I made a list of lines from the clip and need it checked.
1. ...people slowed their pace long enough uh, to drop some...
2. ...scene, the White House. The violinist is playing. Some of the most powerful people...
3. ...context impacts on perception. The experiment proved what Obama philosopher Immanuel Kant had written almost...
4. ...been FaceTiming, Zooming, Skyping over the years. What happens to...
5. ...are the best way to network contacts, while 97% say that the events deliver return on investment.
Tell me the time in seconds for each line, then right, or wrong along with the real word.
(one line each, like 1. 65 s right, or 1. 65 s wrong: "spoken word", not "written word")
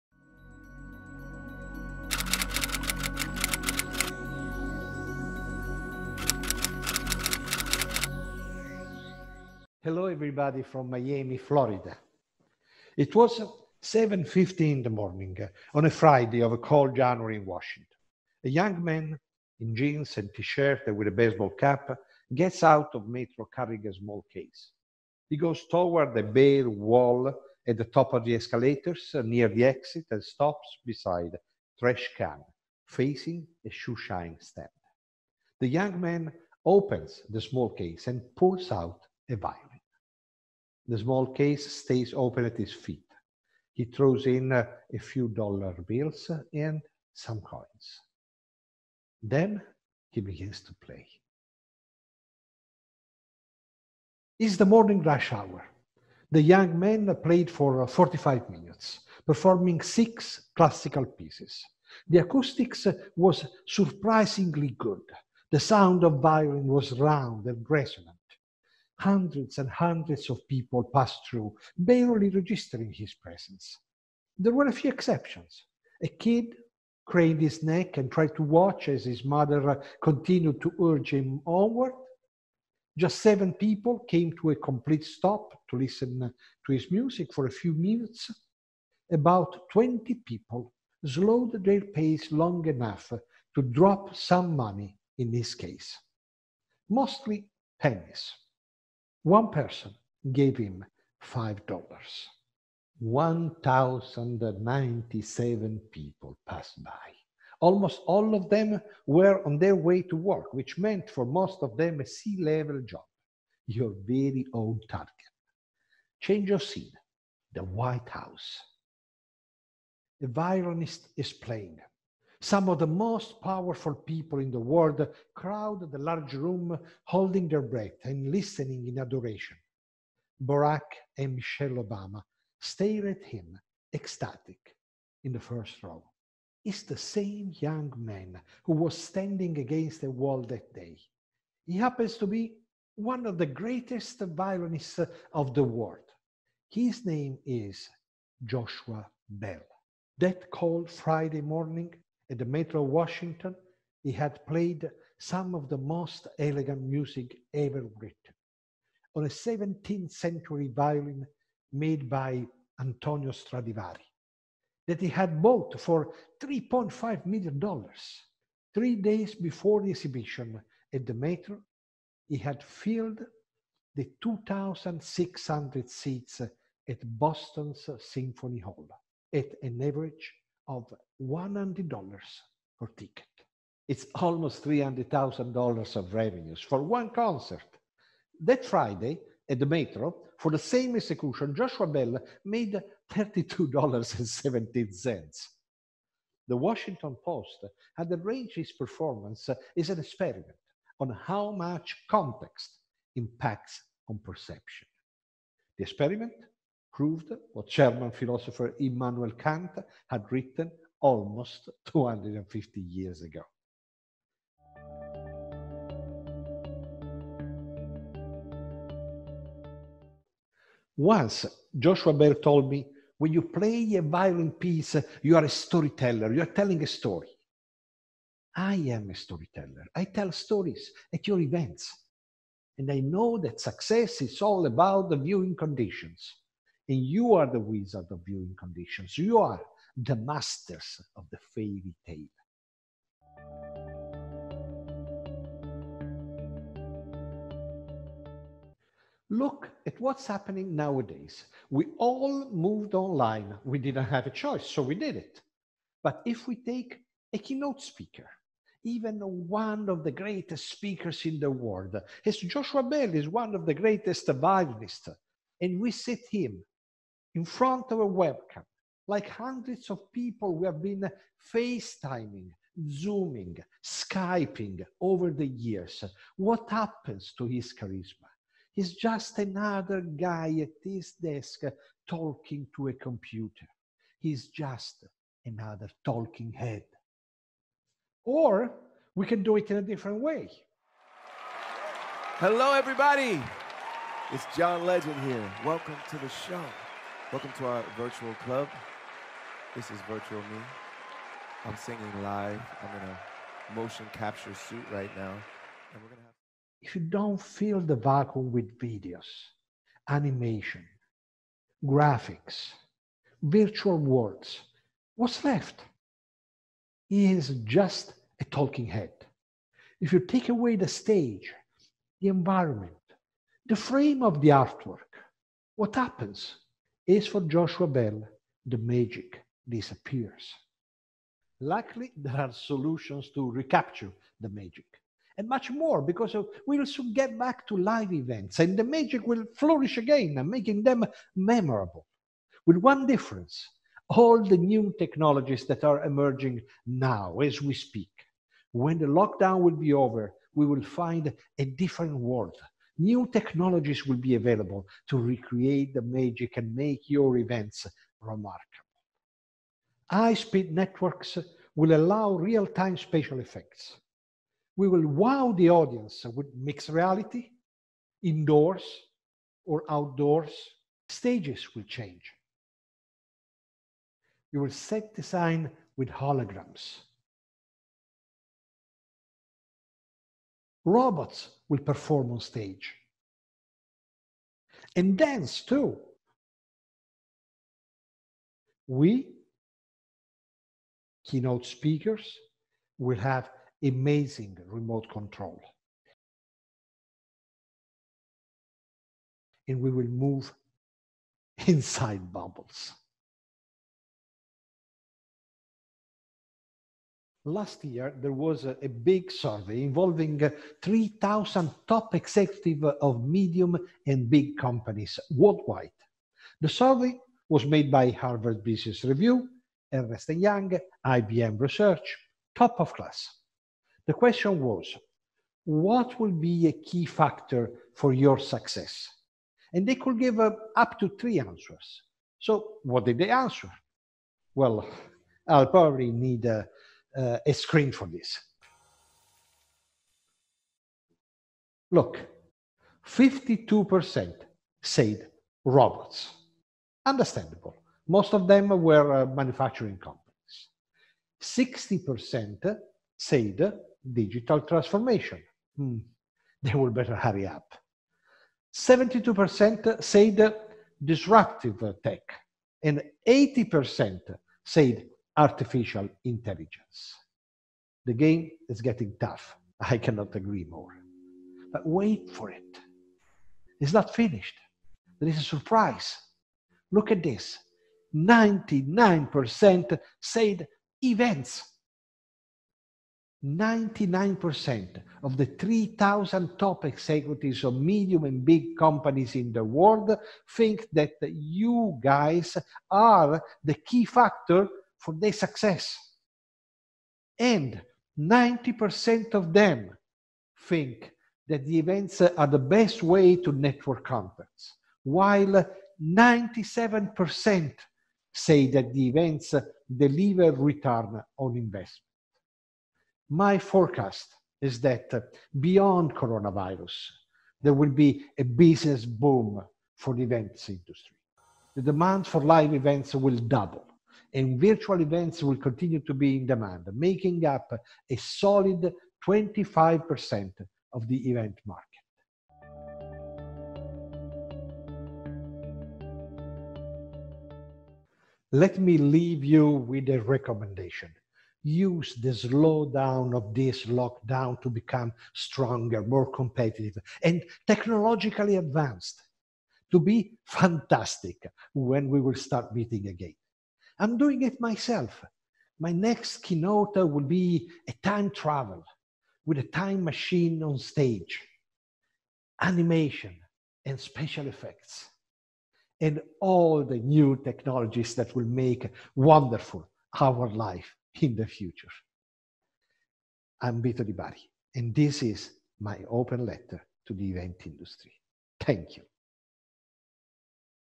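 1. 90 s right
2. 116 s right
3. 202 s wrong: "German", not "Obama"
4. 270 s right
5. 502 s right.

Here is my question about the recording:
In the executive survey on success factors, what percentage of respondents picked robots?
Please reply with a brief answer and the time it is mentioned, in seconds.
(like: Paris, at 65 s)
52%, at 443 s.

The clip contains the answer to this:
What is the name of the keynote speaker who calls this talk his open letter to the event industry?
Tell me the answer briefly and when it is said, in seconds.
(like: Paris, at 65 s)
Vito Di Bari, at 573 s.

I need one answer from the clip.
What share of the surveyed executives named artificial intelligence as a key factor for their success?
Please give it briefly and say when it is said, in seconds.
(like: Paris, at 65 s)
80%, at 463 s.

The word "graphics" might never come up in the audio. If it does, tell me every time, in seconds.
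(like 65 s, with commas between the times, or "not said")
311 s.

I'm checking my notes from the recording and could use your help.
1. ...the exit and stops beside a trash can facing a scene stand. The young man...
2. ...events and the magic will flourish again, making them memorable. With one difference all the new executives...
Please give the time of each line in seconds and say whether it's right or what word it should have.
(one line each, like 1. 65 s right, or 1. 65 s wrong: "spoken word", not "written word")
1. 29 s wrong: "shoeshine", not "scene"
2. 338 s wrong: "technologies", not "executives".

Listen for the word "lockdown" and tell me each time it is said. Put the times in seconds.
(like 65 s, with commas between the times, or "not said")
349 s, 543 s.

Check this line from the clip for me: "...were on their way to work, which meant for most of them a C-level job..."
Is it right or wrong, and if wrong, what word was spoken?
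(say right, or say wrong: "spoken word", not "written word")
right.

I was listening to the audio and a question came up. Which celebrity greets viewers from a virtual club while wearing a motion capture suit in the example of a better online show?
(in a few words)
John Legend.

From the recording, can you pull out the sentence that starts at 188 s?
That Friday at the Metro, for the same execution, Joshua Bell made $32.17.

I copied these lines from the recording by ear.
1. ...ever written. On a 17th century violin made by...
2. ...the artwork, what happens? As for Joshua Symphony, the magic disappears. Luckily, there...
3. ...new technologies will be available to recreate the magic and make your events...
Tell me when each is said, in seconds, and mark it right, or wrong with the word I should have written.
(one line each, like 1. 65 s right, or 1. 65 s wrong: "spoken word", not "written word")
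1. 157 s right
2. 324 s wrong: "Bell", not "Symphony"
3. 353 s right.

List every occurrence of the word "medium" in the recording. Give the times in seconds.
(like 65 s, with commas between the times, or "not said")
413 s, 487 s.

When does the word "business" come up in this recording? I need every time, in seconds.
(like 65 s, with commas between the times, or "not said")
418 s, 518 s.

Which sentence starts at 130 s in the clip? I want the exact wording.
Barack and Michelle Obama stare at him, ecstatic, in the first row.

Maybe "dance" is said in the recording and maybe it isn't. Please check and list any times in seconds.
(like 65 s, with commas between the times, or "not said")
385 s.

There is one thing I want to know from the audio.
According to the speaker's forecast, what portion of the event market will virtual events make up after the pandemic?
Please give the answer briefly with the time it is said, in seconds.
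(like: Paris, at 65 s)
25%, at 529 s.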